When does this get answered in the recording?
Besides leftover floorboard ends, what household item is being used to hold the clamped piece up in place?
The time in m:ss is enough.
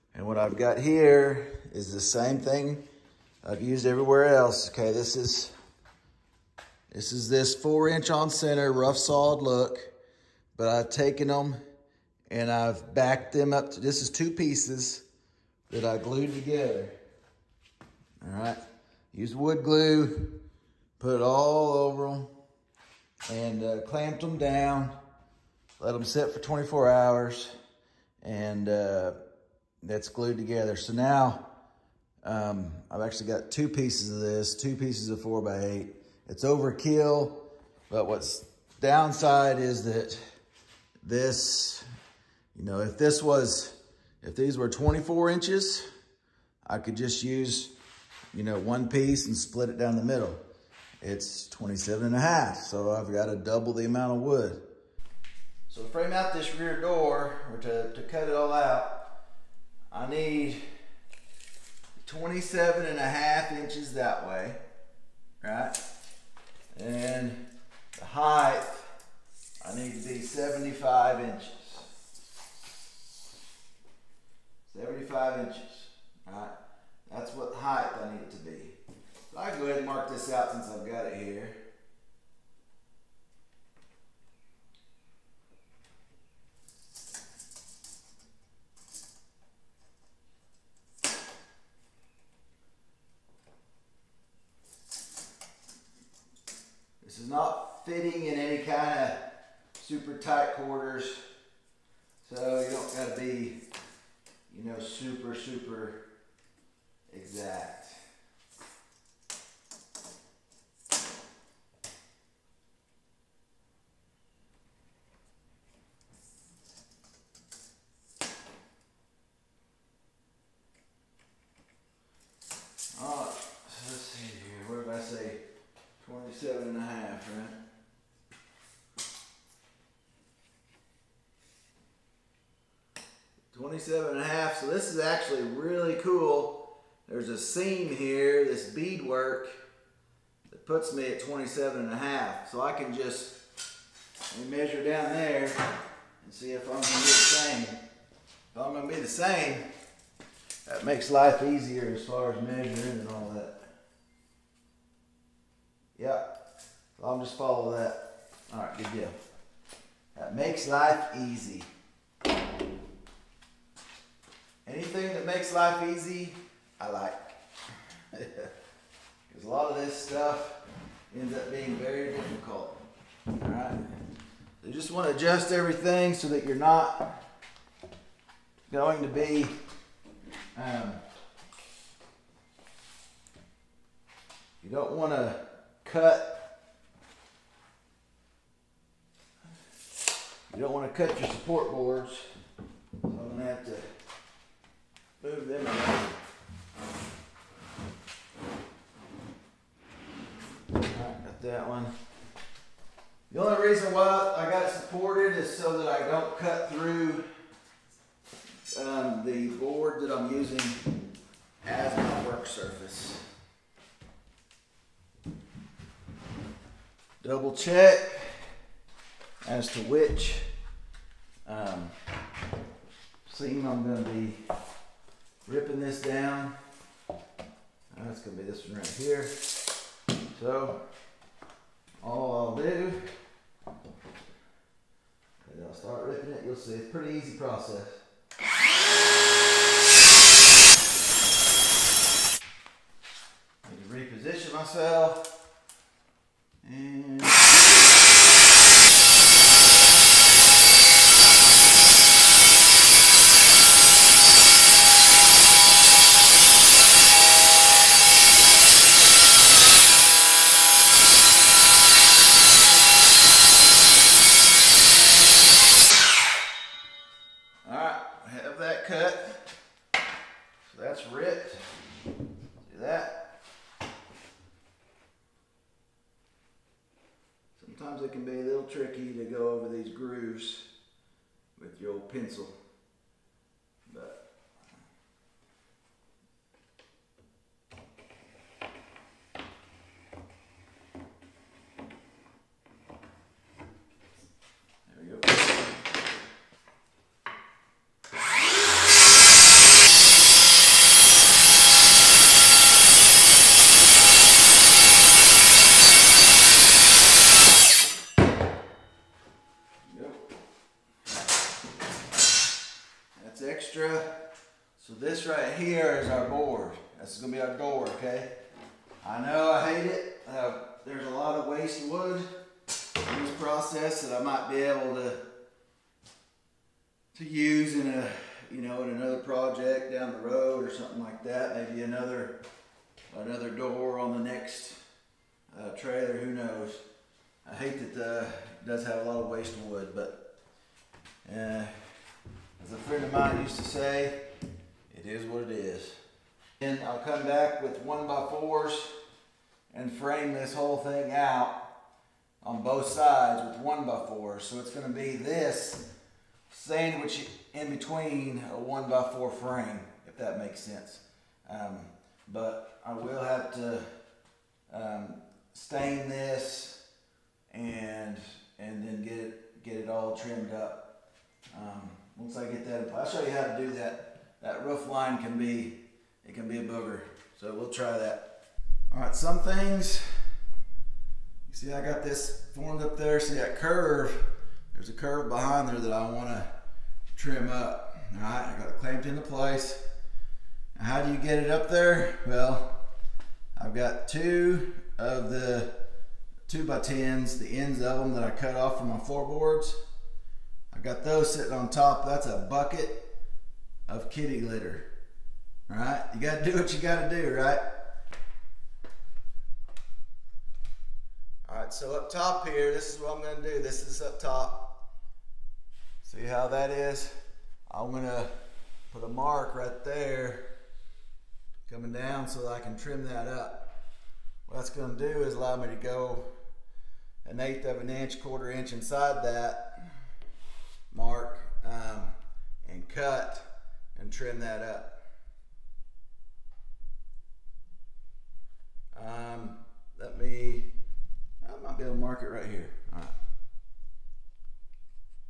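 6:42.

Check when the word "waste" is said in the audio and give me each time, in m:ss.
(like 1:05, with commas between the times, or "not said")
5:21, 5:39.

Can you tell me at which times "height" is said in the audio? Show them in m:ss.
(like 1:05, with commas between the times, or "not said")
1:08, 1:17.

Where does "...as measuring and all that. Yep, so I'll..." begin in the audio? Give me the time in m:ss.
2:32.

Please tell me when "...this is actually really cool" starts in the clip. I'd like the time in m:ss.
2:14.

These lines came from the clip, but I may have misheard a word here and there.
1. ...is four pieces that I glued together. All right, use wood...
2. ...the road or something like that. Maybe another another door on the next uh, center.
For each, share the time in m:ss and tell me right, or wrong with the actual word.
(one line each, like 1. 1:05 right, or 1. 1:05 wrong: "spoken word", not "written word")
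1. 0:14 wrong: "two", not "four"
2. 5:30 wrong: "trailer", not "center".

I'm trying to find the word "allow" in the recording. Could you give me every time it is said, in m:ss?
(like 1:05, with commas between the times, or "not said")
7:05.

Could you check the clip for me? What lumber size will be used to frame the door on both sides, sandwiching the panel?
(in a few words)
1 by 4.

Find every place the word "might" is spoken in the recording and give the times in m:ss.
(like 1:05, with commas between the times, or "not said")
5:24, 7:21.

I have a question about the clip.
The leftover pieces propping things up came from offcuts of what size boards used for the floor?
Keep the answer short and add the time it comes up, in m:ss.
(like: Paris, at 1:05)
2 by 10s, at 6:36.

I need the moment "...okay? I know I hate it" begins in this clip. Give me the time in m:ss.
5:17.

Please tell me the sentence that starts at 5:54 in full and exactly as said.
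So it's gonna be this sandwich in between a one by four frame, if that makes sense.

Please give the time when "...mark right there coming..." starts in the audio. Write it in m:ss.
6:59.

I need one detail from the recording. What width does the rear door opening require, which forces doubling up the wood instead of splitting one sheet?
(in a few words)
27 and a half inches.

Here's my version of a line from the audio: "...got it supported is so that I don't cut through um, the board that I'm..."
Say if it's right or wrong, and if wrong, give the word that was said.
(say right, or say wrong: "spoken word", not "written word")
right.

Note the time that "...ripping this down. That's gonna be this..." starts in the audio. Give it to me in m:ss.
3:45.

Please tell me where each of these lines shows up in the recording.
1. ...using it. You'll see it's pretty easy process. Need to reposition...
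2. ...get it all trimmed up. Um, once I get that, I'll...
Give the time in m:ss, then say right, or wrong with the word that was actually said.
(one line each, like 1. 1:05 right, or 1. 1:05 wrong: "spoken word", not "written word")
1. 3:56 wrong: "ripping", not "using"
2. 6:09 right.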